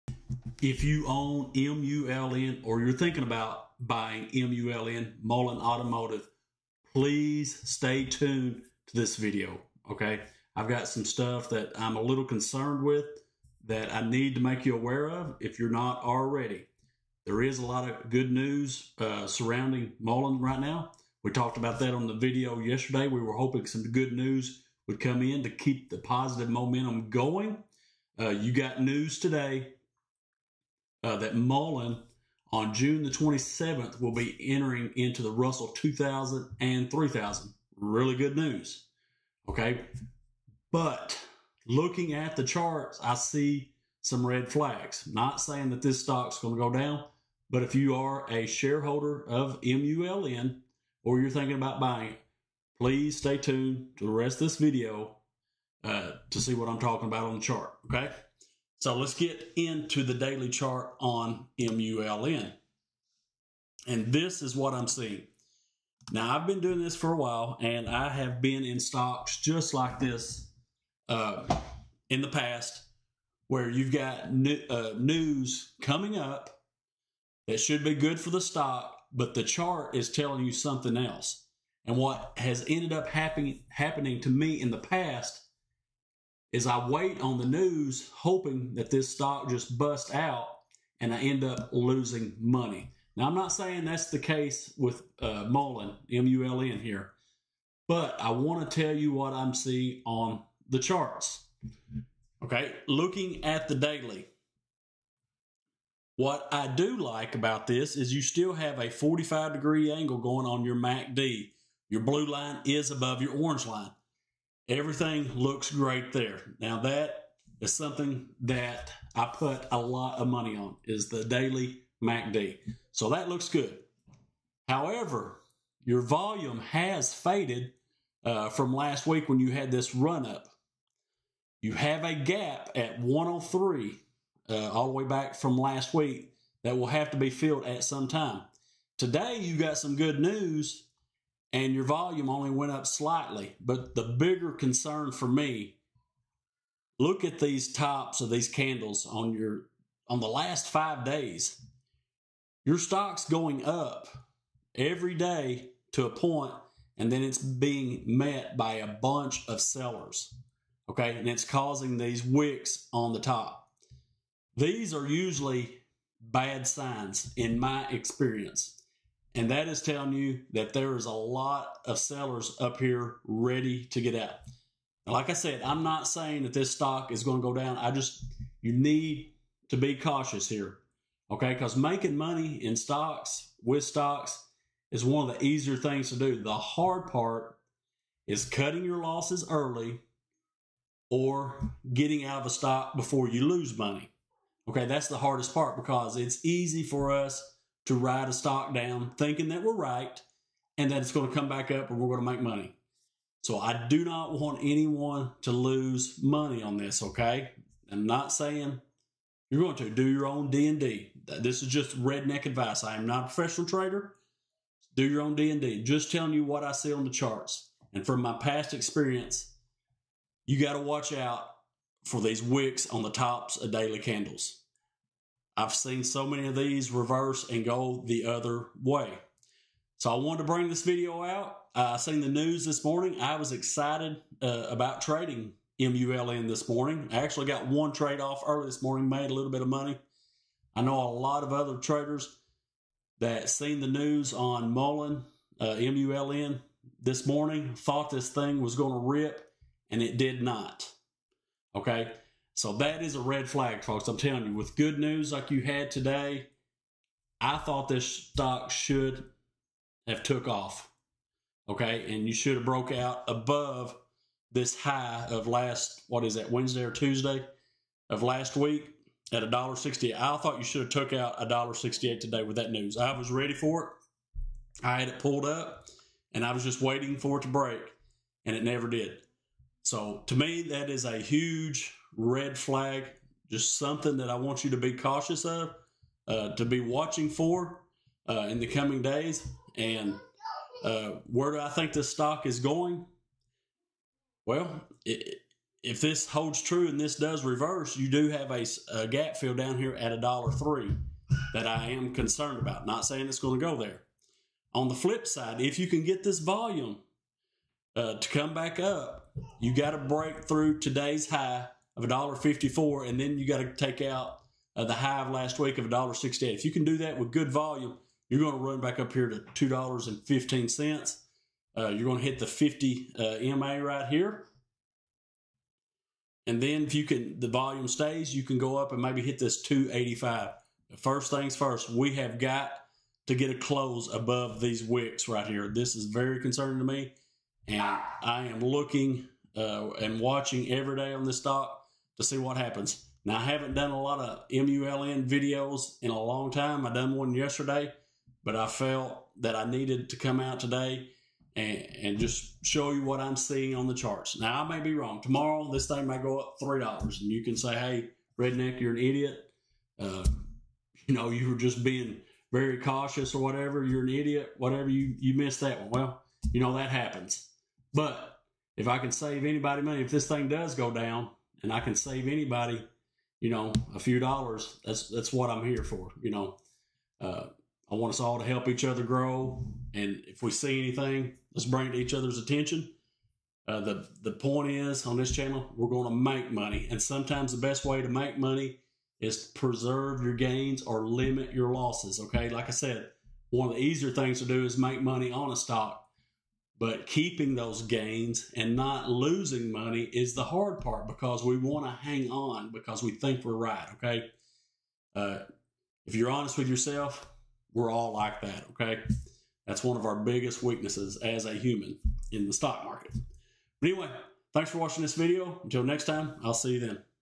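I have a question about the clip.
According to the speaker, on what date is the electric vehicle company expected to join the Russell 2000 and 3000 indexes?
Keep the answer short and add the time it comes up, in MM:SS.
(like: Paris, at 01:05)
June 27, at 00:32.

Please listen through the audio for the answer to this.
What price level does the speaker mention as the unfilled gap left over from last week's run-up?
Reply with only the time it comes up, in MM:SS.
02:13.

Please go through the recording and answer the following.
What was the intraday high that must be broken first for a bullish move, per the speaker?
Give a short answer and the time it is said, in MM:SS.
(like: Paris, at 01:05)
$1.54, at 05:12.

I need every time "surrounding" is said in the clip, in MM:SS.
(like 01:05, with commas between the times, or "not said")
00:19.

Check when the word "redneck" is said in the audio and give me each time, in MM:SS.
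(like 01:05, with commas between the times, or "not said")
03:32, 05:58.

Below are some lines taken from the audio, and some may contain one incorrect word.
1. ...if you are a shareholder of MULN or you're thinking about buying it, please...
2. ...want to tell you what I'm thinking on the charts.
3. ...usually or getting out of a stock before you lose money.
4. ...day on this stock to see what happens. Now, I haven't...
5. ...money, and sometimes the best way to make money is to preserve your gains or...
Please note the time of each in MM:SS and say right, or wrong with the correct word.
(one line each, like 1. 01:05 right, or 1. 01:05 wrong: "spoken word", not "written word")
1. 00:47 right
2. 01:38 wrong: "seeing", not "thinking"
3. 03:09 wrong: "early", not "usually"
4. 05:40 right
5. 06:26 right.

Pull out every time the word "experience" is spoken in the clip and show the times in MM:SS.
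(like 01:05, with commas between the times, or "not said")
02:47, 03:38.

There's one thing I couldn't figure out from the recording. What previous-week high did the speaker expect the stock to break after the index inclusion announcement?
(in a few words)
$1.68.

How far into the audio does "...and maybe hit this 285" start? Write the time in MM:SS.
05:28.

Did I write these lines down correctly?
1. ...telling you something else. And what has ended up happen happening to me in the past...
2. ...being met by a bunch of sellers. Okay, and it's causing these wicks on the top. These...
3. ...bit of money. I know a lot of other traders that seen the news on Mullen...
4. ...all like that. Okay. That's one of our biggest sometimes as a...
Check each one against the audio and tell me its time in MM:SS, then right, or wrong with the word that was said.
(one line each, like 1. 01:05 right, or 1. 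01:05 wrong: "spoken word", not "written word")
1. 01:20 right
2. 02:37 right
3. 03:59 right
4. 06:47 wrong: "weaknesses", not "sometimes".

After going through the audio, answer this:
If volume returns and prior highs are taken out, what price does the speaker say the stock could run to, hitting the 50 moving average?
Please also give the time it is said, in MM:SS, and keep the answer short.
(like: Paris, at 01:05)
$2.15, at 05:19.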